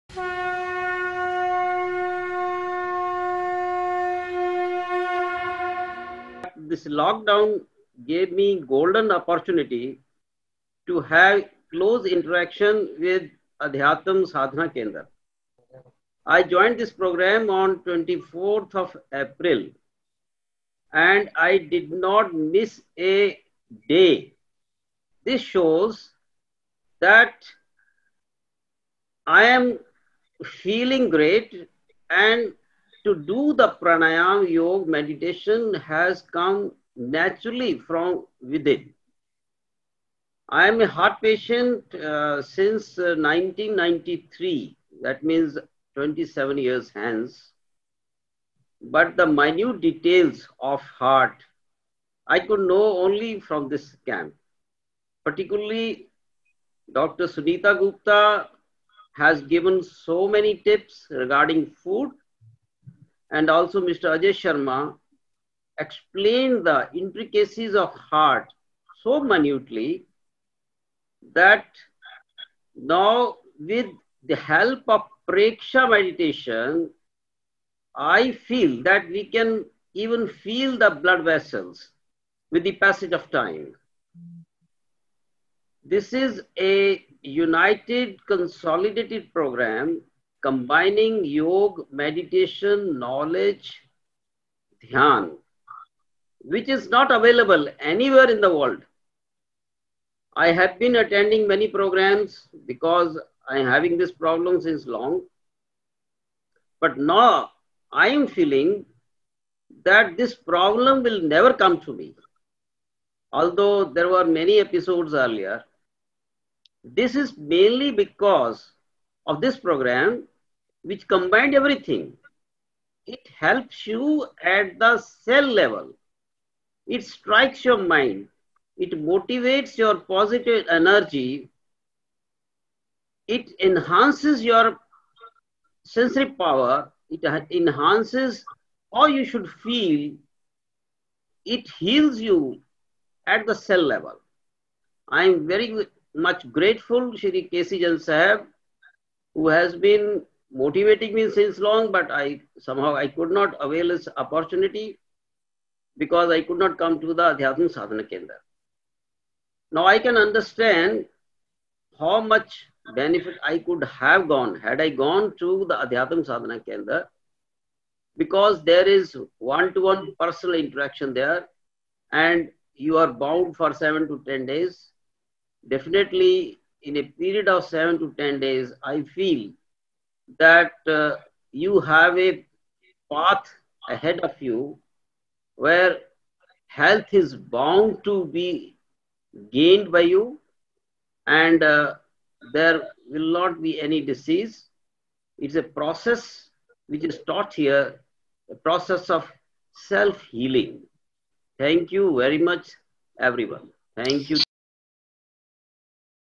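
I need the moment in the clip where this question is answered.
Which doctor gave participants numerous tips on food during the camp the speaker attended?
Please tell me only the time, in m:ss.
0:56.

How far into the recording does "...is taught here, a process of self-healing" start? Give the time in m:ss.
3:17.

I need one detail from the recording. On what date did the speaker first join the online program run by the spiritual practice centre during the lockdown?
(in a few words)
24 April.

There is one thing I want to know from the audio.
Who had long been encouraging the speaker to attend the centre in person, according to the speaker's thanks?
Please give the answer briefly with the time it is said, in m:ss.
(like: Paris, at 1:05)
K.C. Jain, at 2:27.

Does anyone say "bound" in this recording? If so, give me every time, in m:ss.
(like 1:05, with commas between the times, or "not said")
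2:53, 3:07.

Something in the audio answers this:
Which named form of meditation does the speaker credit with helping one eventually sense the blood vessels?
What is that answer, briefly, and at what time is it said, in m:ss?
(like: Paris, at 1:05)
Preksha meditation, at 1:15.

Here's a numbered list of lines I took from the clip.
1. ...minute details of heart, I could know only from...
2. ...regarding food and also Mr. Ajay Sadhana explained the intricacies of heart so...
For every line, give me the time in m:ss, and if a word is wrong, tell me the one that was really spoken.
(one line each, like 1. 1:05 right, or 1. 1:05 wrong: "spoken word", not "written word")
1. 0:49 right
2. 1:01 wrong: "Sharma", not "Sadhana".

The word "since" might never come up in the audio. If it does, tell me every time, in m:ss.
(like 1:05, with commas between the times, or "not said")
0:42, 1:44, 2:31.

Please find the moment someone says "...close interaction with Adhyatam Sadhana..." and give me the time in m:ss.
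0:11.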